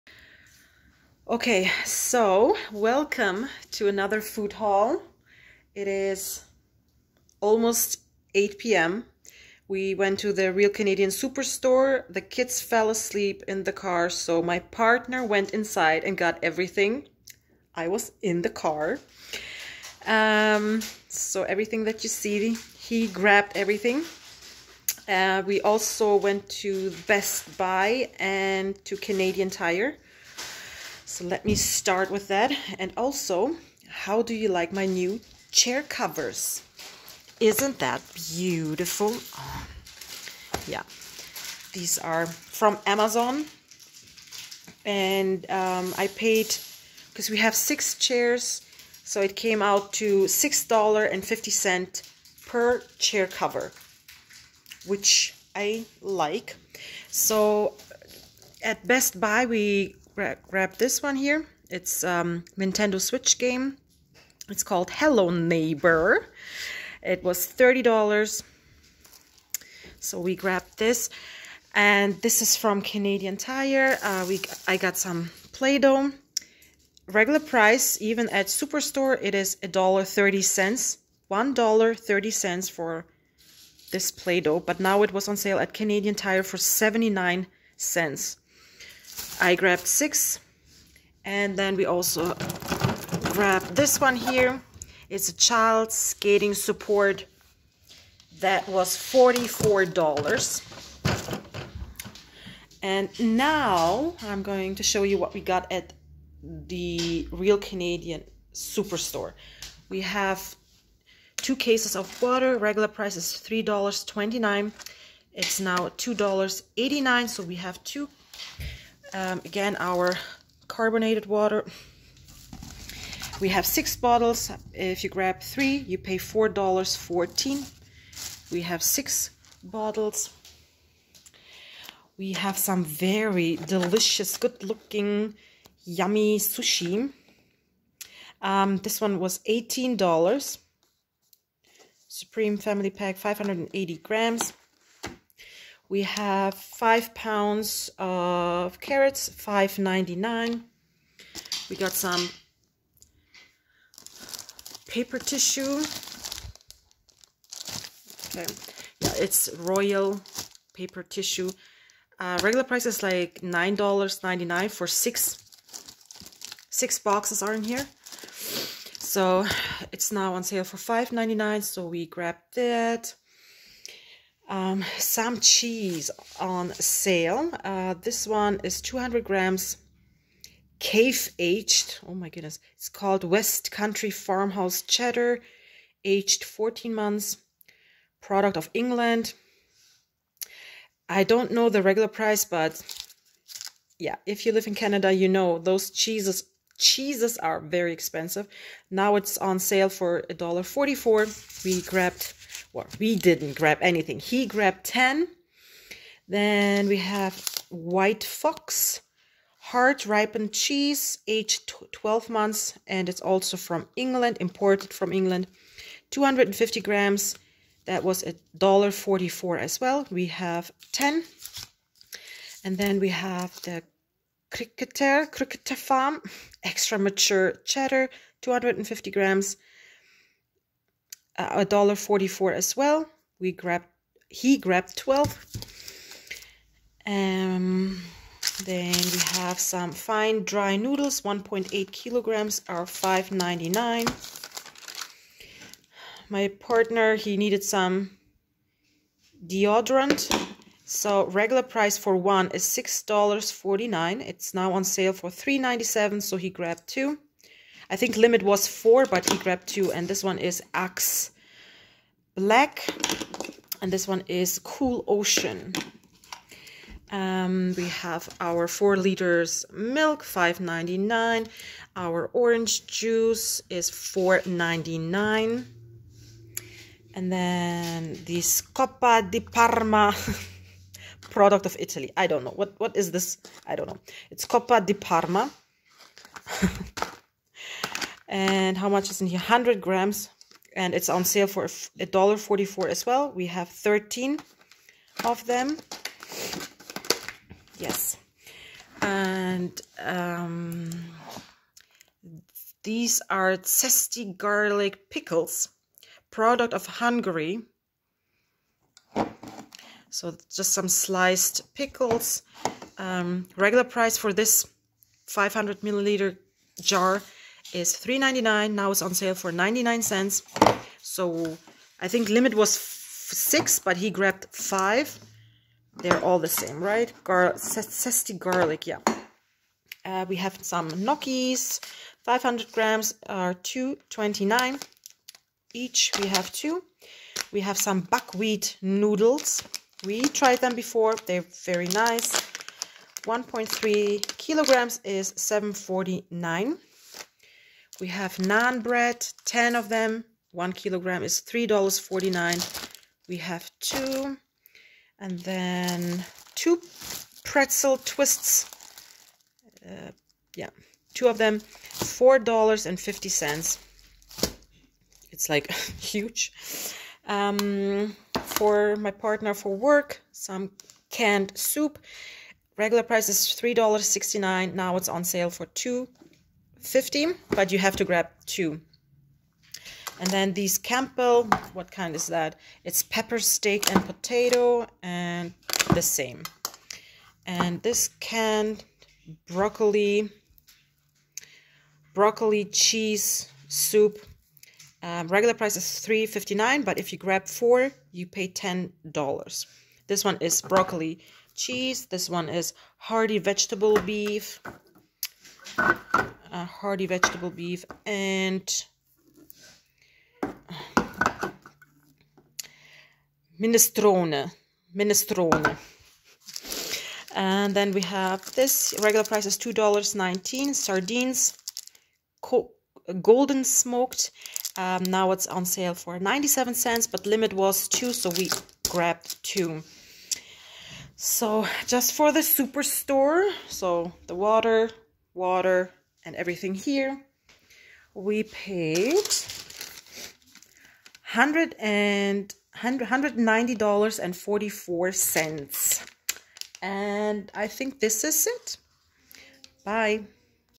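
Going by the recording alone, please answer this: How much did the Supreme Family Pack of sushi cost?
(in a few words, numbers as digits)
$18.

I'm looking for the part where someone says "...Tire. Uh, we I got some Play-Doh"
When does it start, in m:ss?
1:13.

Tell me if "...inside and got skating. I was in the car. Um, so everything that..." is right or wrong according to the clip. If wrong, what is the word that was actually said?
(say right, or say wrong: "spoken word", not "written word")
wrong: "everything", not "skating".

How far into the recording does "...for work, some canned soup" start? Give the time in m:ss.
6:09.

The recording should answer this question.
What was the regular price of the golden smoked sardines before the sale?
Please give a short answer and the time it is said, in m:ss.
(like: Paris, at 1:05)
$2.19, at 6:59.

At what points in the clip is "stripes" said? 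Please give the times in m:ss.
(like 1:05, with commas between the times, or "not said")
not said.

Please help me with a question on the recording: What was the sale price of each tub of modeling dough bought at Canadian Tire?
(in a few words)
79 cents.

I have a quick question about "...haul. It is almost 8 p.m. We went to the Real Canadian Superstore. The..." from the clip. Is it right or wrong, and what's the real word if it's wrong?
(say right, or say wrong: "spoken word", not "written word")
right.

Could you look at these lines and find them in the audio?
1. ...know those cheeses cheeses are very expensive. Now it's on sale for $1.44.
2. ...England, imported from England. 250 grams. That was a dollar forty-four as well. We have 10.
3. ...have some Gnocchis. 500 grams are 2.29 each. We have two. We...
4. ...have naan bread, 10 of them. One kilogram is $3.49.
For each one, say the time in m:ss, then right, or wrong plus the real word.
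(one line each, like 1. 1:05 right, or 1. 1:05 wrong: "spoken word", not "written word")
1. 3:15 right
2. 3:33 right
3. 5:30 right
4. 5:48 right.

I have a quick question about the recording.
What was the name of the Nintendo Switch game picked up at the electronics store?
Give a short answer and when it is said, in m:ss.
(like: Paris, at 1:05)
Hello Neighbor, at 1:04.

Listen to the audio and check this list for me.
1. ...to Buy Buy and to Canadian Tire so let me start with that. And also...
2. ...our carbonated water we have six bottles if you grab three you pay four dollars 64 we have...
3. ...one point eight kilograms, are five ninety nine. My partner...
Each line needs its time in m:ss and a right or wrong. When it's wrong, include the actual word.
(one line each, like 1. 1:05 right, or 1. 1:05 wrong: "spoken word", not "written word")
1. 0:26 wrong: "Best", not "Buy"
2. 1:59 wrong: "14", not "64"
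3. 4:01 right.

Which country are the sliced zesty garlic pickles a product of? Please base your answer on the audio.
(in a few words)
Hungary.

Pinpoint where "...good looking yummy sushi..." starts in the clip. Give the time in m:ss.
2:14.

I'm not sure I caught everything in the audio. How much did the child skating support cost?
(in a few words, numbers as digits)
$44.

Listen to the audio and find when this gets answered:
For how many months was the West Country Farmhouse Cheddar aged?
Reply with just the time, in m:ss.
3:06.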